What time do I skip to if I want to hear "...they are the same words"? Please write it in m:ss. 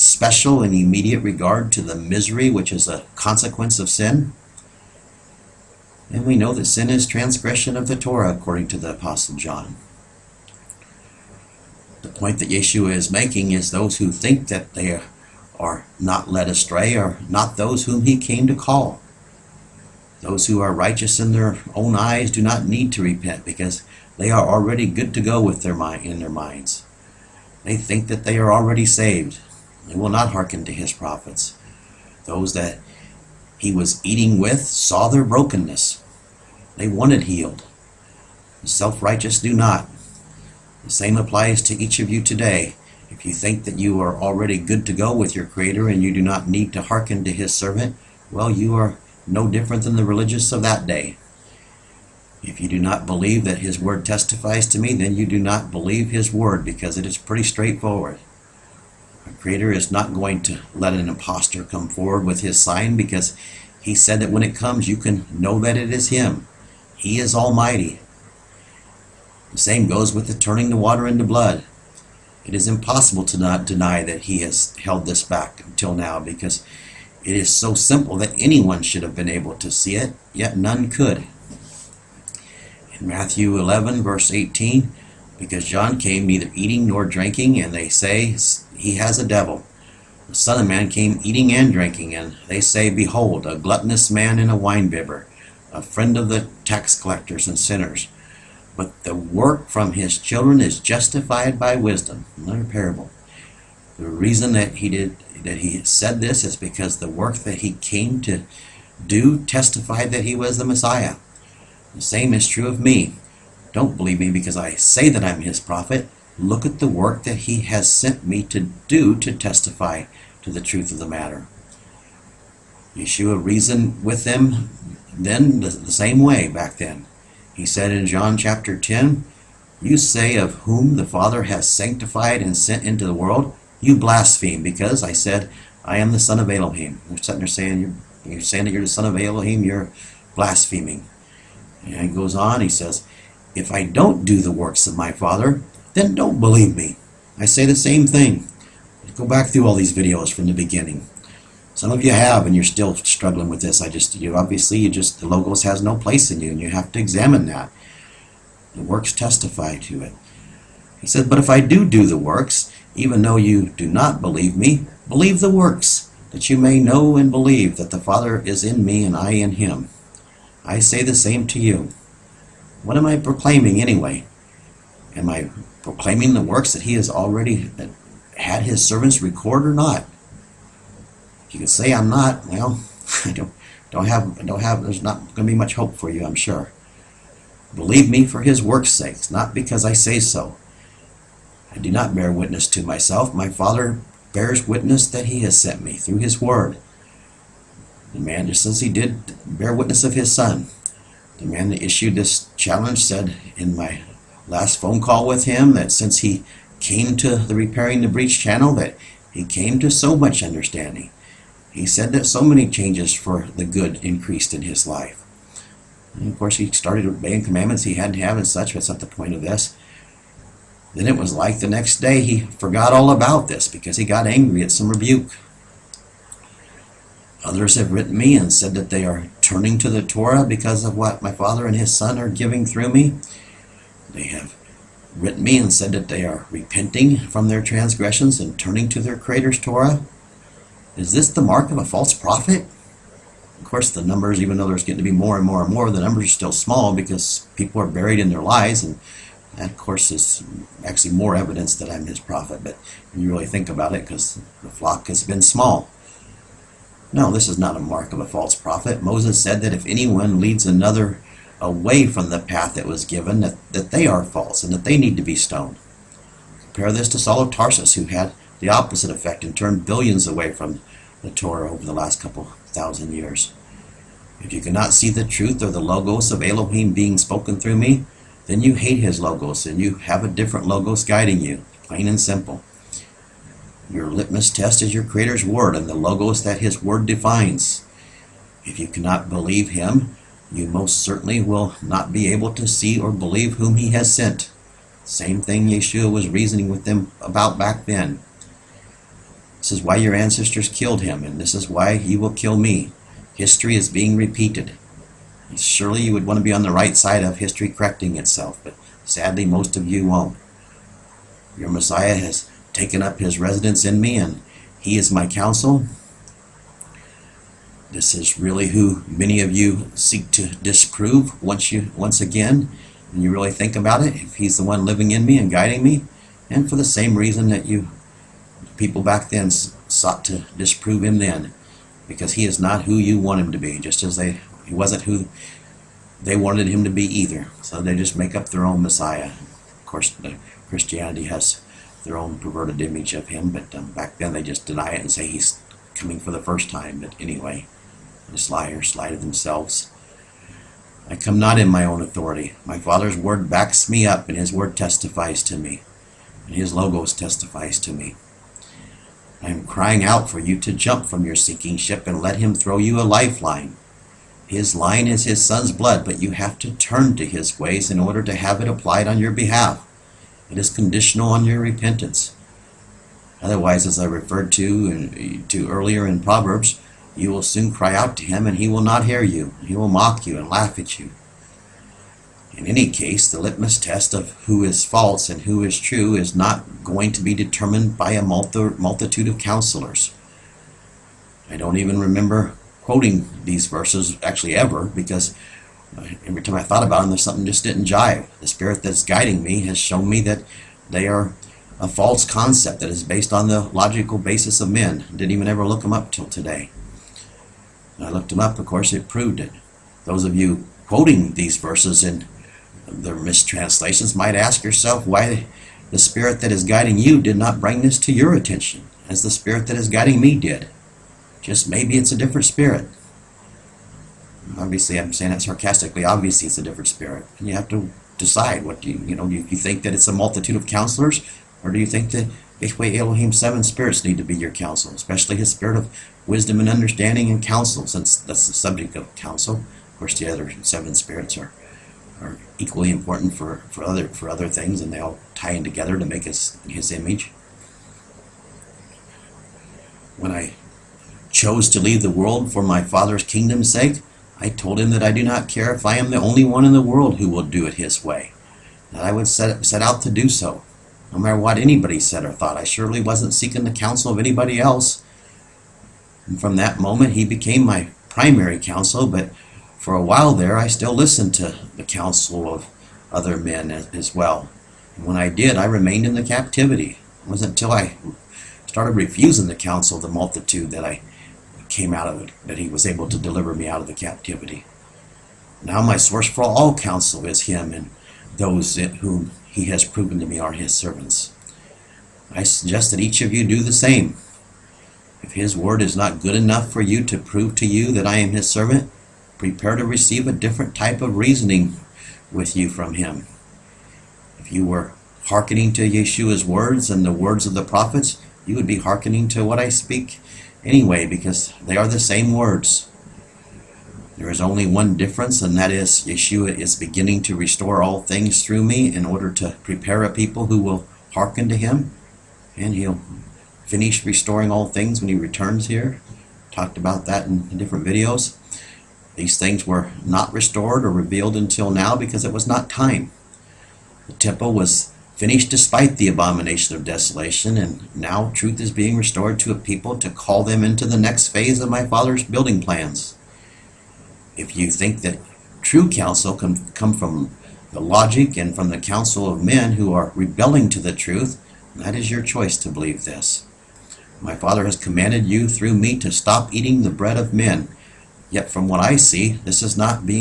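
8:31.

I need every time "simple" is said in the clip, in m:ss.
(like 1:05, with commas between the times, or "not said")
1:17, 4:42.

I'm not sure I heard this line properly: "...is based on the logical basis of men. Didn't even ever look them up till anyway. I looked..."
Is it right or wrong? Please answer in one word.
wrong.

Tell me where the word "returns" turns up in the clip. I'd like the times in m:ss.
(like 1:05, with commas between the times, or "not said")
8:45.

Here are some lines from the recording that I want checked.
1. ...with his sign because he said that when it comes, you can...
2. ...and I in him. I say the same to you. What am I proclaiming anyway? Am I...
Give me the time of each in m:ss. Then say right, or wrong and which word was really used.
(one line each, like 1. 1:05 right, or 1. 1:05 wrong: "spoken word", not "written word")
1. 1:02 right
2. 2:49 right.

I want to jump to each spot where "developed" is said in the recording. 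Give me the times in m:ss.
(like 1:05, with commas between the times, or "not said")
not said.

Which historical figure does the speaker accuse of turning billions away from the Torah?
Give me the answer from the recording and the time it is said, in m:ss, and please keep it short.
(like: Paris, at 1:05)
Saul of Tarsus, at 4:27.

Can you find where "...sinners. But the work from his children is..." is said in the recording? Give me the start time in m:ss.
1:37.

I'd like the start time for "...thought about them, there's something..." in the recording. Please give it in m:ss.
6:36.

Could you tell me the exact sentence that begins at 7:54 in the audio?
And when I did, I remained in the captivity.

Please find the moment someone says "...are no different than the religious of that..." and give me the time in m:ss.
0:48.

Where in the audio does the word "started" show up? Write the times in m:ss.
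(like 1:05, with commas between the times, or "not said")
3:36, 7:58.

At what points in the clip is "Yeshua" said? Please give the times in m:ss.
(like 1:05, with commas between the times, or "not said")
0:12, 2:02, 4:55, 8:25, 8:36.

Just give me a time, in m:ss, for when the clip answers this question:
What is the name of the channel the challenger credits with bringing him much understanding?
3:27.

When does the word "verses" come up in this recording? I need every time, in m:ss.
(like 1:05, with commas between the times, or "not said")
1:24, 6:33, 6:51.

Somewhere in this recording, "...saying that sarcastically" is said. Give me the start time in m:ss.
7:05.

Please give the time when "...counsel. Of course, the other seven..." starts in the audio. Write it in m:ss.
7:19.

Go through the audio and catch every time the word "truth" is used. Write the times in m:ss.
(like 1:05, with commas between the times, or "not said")
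2:00, 4:35, 8:58, 9:10.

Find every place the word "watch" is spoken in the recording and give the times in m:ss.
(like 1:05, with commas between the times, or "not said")
not said.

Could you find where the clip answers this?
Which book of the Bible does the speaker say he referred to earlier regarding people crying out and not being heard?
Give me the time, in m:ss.
6:16.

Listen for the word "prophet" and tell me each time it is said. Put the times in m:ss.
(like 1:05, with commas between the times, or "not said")
0:30, 1:55, 4:02, 4:12, 4:18, 8:27.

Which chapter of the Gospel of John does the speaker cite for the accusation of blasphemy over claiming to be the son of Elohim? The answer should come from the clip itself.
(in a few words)
Chapter 10.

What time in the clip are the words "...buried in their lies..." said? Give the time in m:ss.
4:07.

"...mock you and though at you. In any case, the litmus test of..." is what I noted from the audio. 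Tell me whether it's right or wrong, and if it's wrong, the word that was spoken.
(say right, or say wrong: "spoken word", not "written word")
wrong: "laugh", not "though".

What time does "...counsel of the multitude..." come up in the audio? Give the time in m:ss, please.
7:59.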